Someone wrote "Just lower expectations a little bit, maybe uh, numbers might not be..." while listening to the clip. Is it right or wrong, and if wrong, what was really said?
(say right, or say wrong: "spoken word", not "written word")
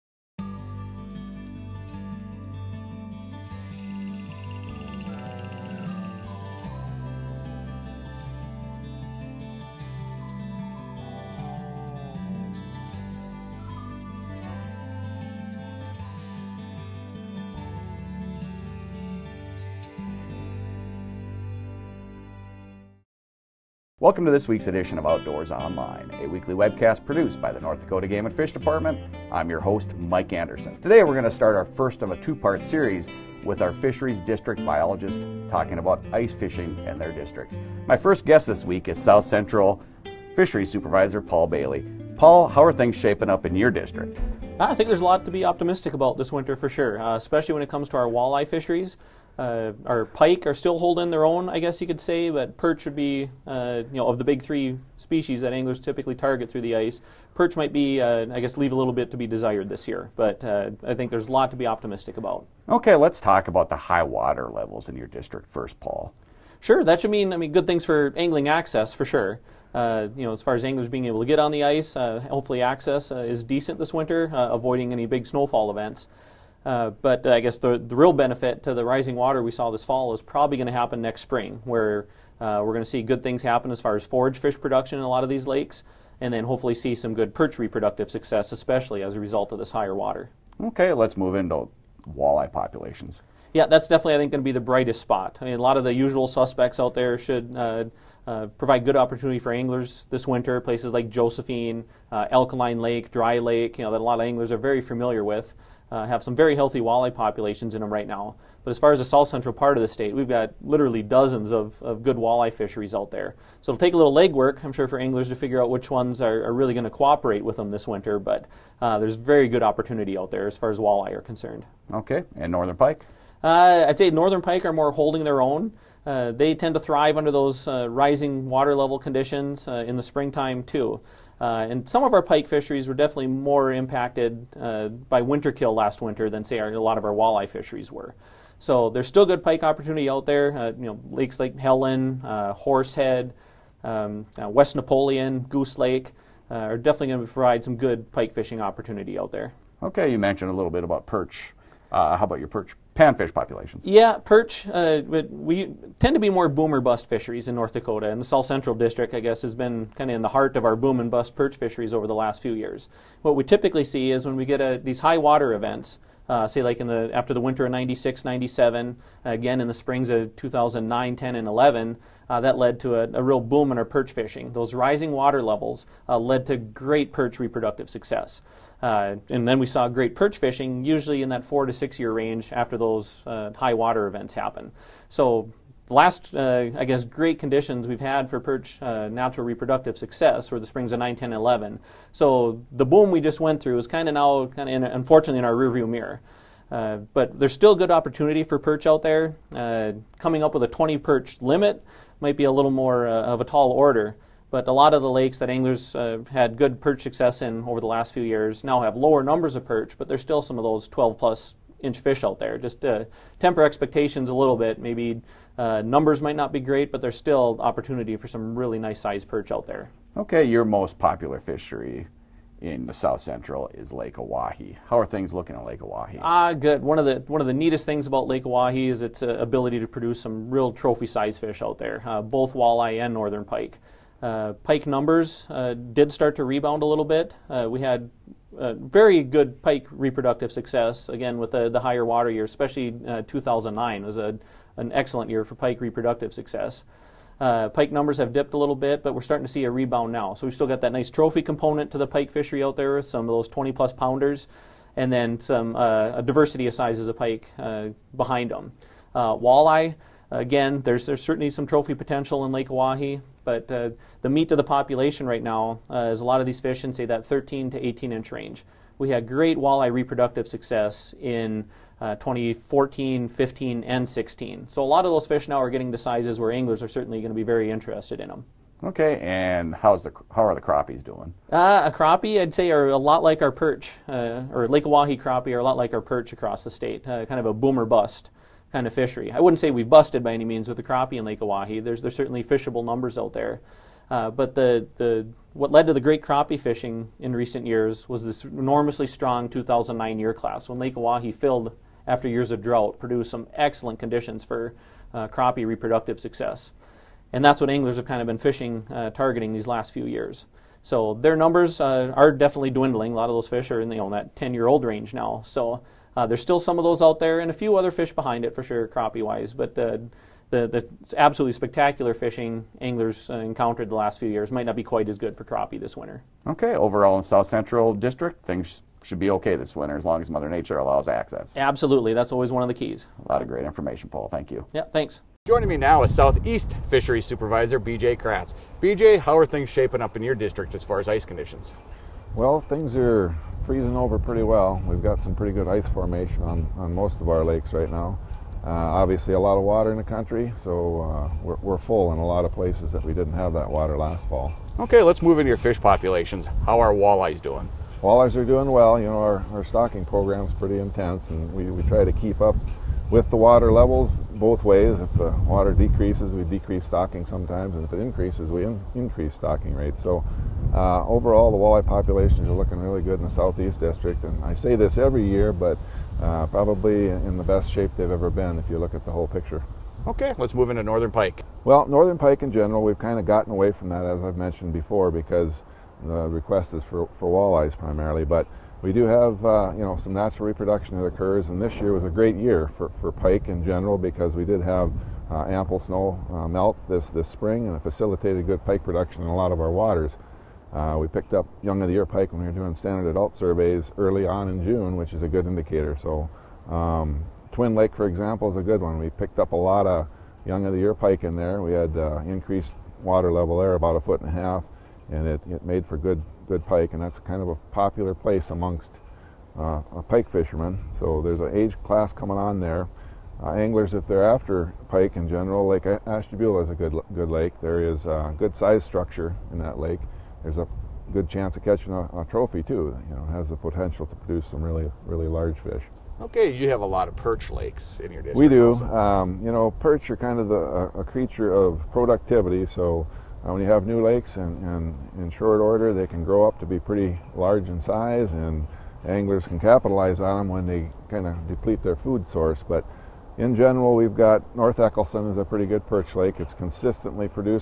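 wrong: "temper", not "lower".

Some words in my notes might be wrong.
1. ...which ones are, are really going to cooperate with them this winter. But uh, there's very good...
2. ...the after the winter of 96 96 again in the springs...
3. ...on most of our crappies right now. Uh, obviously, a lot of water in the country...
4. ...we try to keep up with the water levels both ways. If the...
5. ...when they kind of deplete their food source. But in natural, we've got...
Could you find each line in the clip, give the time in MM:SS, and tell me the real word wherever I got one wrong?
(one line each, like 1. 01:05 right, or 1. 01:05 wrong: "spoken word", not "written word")
1. 01:55 right
2. 02:46 wrong: "97", not "96"
3. 05:46 wrong: "lakes", not "crappies"
4. 06:01 right
5. 07:30 wrong: "general", not "natural".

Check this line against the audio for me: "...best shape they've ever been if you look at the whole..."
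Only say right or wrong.
right.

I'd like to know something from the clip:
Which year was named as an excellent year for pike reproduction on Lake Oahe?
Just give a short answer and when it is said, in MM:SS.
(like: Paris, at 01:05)
2009, at 04:03.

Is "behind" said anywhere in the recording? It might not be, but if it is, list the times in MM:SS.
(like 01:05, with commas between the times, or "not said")
04:18, 05:18.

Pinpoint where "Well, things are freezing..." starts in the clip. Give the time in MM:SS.
05:42.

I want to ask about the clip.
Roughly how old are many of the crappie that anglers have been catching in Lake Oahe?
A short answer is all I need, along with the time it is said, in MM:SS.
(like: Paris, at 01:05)
10 years, at 05:14.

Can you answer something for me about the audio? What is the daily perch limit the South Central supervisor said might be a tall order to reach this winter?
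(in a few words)
20.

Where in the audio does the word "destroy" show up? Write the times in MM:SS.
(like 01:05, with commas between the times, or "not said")
not said.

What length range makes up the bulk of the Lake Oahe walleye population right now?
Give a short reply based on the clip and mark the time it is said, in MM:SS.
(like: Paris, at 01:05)
13 to 18 inches, at 04:27.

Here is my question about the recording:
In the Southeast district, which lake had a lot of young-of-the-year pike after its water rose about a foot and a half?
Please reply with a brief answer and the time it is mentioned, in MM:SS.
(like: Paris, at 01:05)
Twin Lake, at 06:47.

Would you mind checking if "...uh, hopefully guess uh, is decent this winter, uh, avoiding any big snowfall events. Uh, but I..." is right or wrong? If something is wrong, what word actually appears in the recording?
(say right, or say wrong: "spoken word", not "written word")
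wrong: "access", not "guess".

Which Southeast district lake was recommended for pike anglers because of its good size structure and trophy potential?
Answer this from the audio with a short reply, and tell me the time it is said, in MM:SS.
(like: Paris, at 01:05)
Lake Ashtabula, at 07:05.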